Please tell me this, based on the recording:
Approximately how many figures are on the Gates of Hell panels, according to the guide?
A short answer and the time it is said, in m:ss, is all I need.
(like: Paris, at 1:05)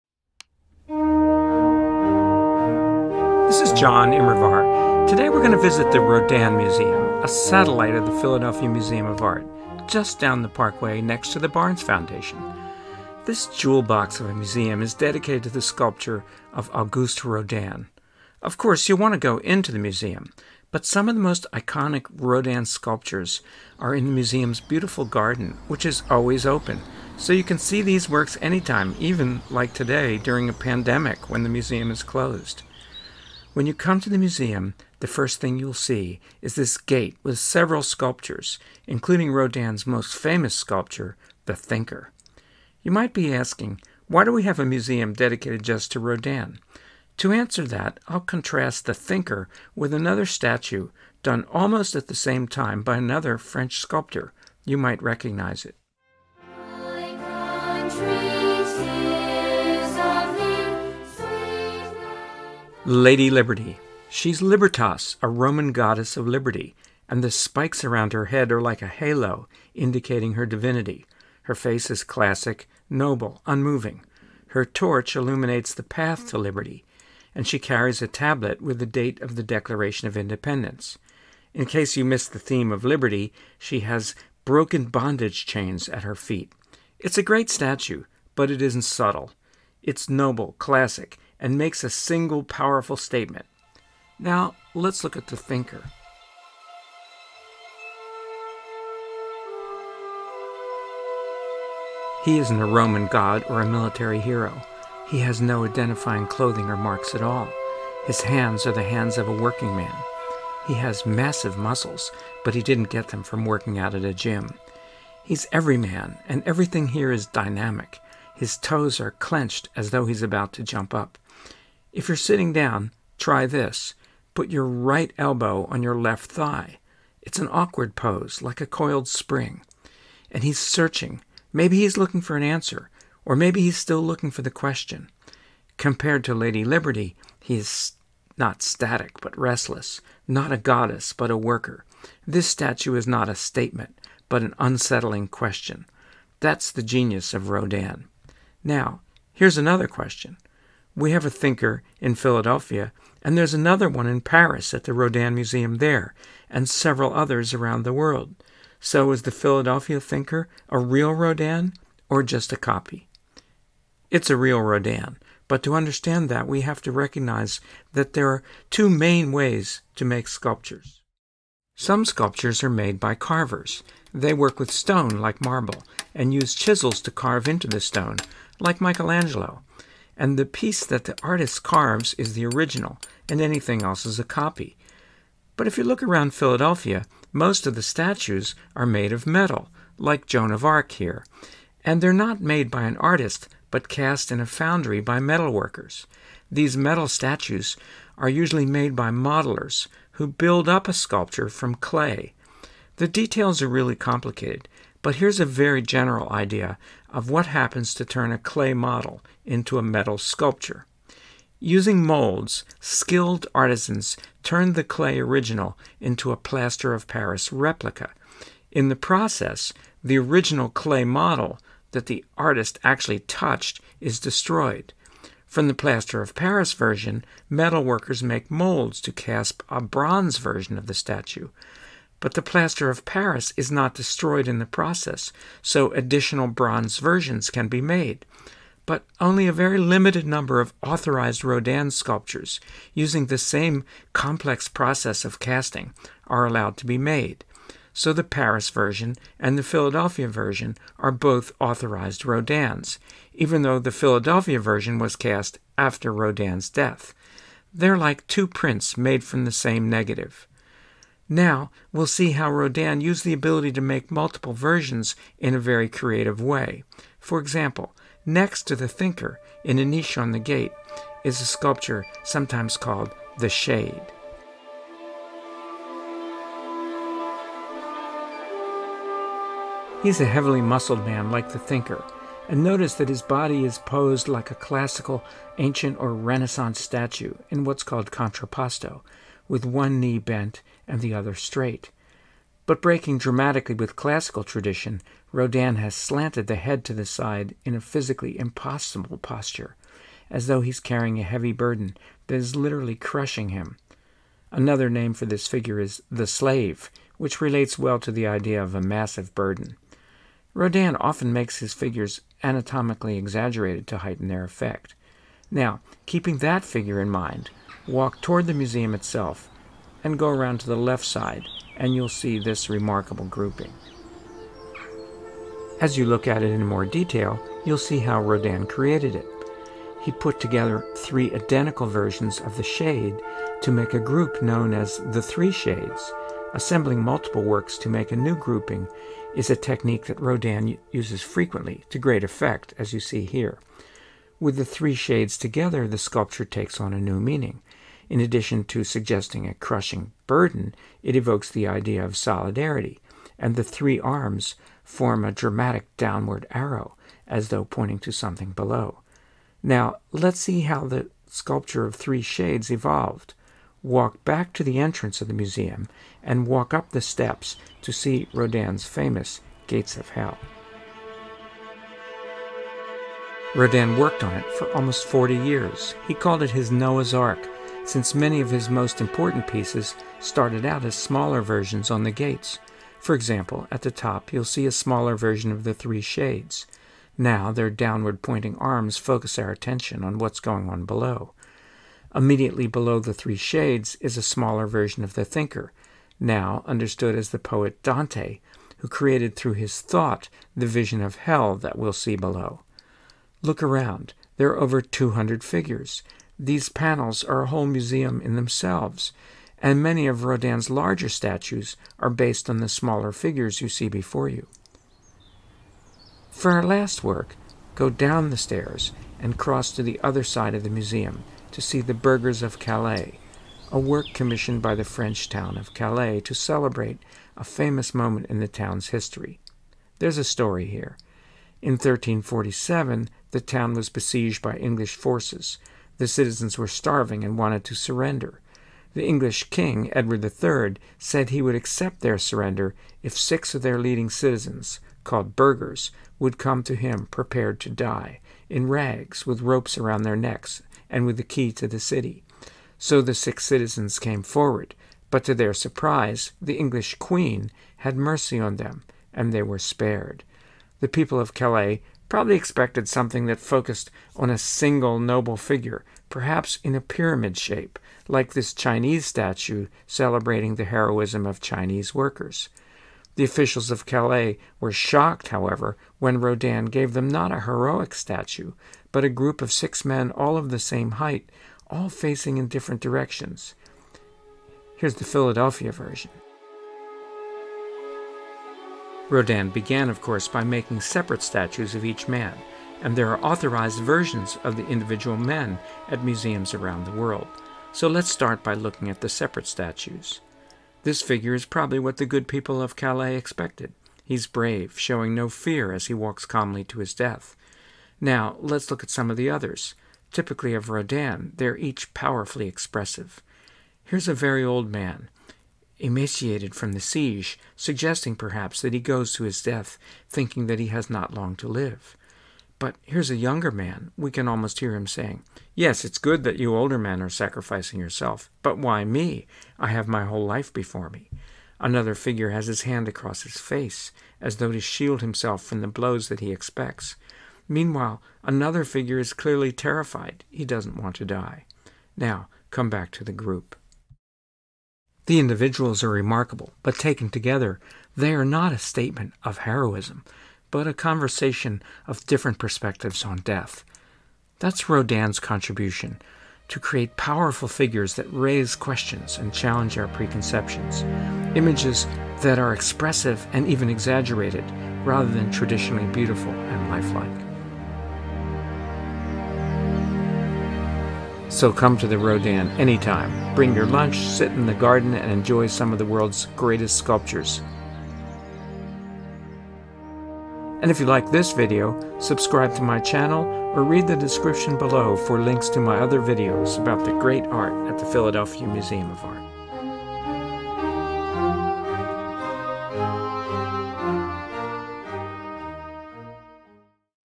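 over 200, at 6:44.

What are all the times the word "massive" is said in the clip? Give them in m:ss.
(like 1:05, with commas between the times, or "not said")
1:51, 5:08.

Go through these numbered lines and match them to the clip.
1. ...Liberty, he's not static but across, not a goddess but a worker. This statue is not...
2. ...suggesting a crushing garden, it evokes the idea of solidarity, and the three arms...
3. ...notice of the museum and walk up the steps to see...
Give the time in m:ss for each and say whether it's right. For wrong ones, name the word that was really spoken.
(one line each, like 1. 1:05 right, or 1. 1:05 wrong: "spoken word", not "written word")
1. 2:16 wrong: "restless", not "across"
2. 5:48 wrong: "burden", not "garden"
3. 6:04 wrong: "entrance", not "notice".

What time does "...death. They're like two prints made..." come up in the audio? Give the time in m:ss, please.
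4:16.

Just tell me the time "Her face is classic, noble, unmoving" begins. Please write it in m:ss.
1:11.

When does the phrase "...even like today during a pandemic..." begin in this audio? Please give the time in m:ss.
0:28.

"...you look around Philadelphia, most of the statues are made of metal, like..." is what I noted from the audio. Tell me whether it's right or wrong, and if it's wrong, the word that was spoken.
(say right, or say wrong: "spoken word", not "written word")
right.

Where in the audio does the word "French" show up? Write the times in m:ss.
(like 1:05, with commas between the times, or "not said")
0:53, 7:04.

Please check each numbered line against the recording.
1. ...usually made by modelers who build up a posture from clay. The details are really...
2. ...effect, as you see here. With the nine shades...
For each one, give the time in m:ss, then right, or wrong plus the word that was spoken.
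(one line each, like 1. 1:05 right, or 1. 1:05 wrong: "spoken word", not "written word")
1. 3:18 wrong: "sculpture", not "posture"
2. 5:42 wrong: "three", not "nine".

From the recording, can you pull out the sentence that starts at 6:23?
For example, at the top you'll see a smaller version of the three shades.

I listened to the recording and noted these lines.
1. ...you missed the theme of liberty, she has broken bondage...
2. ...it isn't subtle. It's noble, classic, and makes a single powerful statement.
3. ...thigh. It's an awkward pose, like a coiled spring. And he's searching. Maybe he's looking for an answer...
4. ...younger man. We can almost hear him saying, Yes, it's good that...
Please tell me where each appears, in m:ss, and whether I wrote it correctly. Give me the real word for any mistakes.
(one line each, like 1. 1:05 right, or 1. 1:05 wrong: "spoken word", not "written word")
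1. 1:21 right
2. 1:28 right
3. 2:06 right
4. 8:43 right.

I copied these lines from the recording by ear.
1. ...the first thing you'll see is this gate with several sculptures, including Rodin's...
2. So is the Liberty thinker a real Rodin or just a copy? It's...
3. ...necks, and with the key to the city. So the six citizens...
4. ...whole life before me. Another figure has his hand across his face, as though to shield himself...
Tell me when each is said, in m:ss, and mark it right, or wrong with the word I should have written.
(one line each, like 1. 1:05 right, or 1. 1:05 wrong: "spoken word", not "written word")
1. 0:35 right
2. 2:38 wrong: "Philadelphia", not "Liberty"
3. 7:30 right
4. 8:50 right.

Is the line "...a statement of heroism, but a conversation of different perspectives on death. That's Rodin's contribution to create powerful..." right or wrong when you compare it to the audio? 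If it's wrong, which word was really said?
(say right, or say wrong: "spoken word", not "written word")
right.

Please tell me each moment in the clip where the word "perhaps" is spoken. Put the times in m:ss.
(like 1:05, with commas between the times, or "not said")
7:46, 8:38.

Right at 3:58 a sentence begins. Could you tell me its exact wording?
But only a very limited number of authorized Rodin sculptures, using the same complex process of casting, are allowed to be made.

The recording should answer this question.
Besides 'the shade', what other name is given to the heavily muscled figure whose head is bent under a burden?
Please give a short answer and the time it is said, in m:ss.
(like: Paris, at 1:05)
The Slave, at 5:06.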